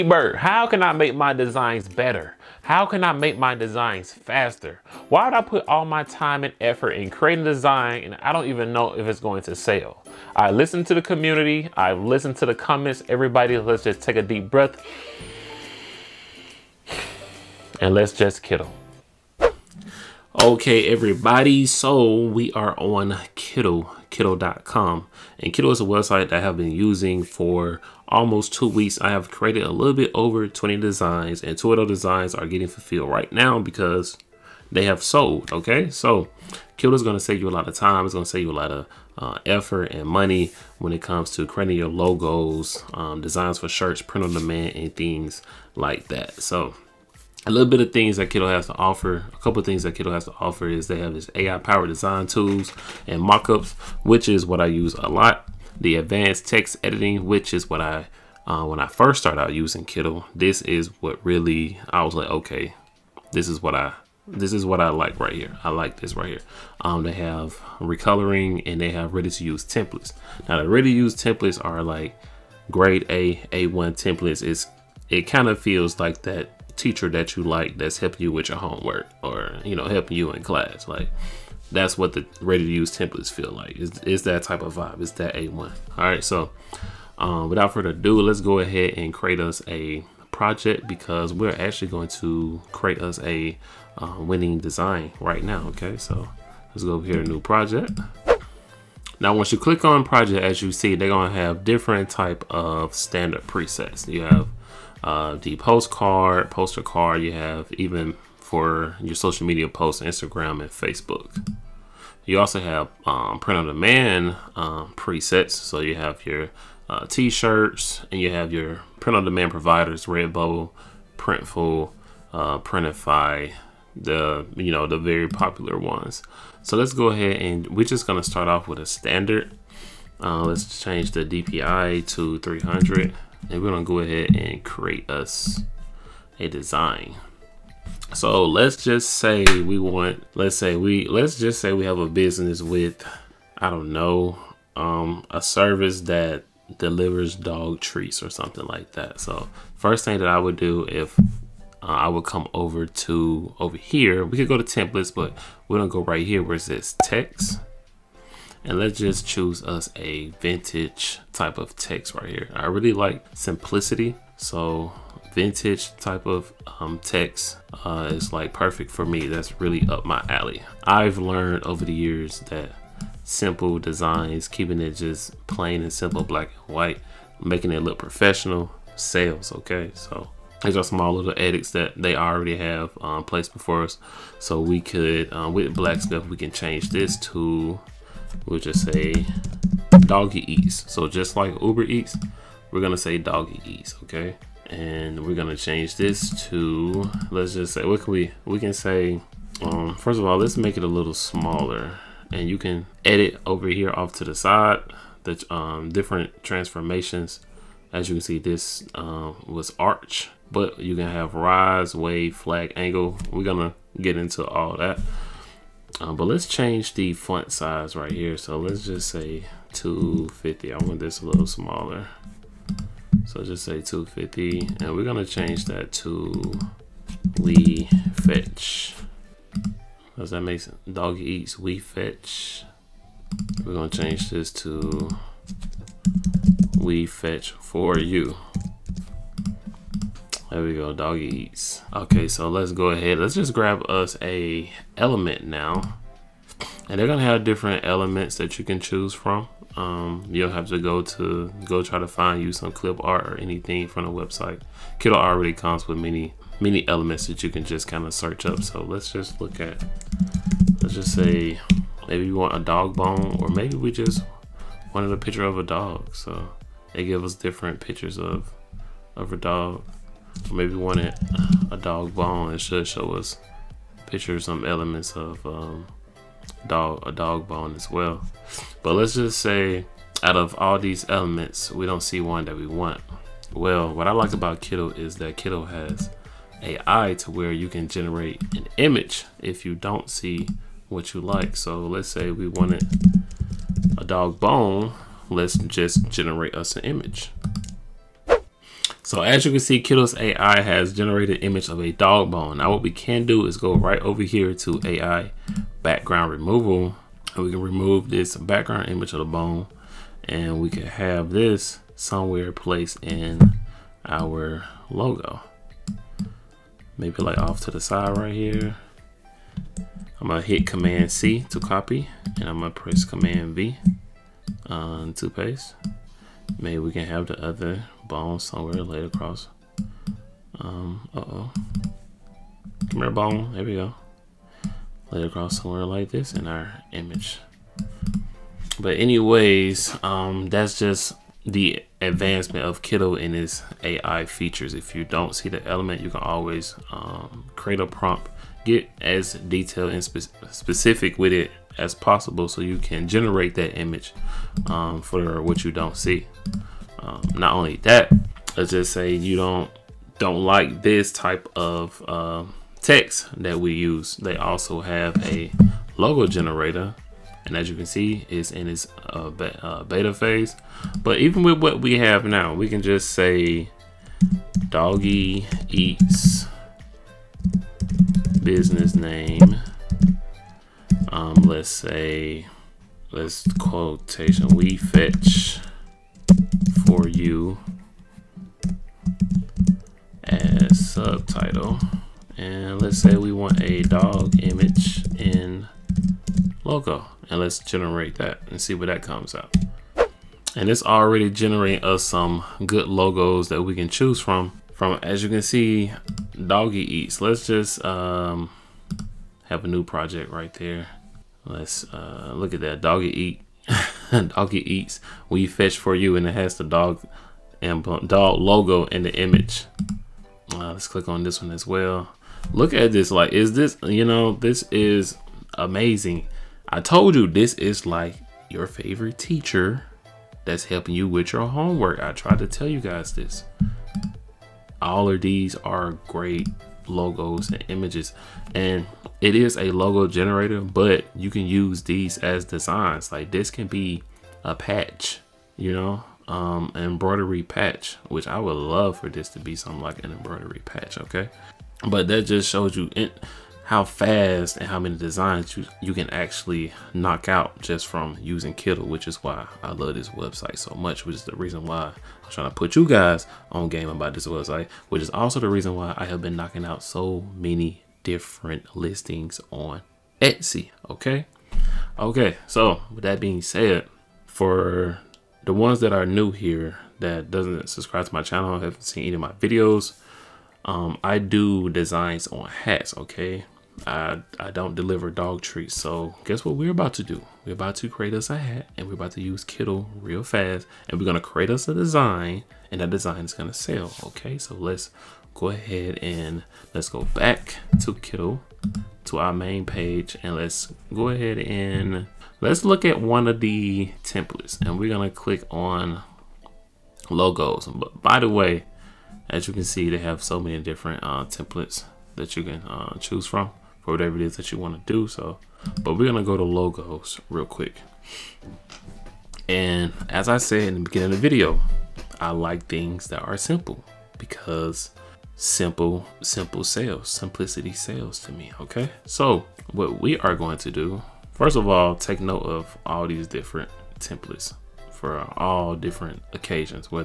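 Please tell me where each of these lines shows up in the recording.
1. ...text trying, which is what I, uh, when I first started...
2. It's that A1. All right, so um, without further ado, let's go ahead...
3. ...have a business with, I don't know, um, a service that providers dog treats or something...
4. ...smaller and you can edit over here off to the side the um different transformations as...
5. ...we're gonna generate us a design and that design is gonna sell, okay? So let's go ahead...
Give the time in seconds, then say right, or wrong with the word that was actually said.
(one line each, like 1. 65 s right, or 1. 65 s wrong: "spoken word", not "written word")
1. 56 s wrong: "editing", not "trying"
2. 85 s right
3. 141 s wrong: "delivers", not "providers"
4. 201 s right
5. 490 s wrong: "create", not "generate".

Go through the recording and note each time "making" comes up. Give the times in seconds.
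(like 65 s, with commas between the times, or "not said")
177 s.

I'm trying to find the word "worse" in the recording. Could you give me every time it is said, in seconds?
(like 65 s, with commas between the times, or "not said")
not said.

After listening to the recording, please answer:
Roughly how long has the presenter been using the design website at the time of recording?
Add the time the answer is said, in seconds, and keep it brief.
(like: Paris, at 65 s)
almost two weeks, at 28 s.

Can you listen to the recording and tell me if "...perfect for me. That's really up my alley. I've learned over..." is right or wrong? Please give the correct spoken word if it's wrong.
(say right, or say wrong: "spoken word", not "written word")
right.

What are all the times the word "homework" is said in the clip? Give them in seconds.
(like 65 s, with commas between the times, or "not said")
78 s, 431 s.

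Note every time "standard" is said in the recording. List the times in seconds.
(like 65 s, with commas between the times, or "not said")
102 s, 128 s.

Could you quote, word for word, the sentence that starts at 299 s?
So as you can see, Kittl's AI has generated image of a dog bone.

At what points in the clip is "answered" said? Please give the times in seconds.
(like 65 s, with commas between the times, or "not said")
not said.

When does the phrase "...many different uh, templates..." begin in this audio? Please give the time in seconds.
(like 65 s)
510 s.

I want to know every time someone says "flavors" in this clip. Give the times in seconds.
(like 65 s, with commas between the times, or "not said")
not said.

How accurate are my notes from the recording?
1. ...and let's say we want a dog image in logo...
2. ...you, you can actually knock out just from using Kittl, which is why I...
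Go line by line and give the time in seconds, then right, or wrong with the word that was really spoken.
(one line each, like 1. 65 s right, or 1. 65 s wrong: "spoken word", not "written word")
1. 392 s right
2. 455 s right.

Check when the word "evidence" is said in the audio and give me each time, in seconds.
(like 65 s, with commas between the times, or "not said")
not said.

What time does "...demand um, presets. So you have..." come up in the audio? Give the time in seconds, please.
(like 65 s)
113 s.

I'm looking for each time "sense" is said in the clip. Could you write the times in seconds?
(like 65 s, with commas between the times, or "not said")
230 s.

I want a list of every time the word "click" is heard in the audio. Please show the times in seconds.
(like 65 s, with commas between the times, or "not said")
99 s, 420 s, 505 s.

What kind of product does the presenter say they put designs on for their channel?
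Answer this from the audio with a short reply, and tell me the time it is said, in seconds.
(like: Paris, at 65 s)
hats, at 482 s.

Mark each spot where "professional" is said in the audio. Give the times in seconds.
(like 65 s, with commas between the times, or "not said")
177 s.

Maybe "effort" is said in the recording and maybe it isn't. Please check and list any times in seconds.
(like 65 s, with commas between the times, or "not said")
6 s, 39 s.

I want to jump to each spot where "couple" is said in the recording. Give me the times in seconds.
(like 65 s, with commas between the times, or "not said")
49 s.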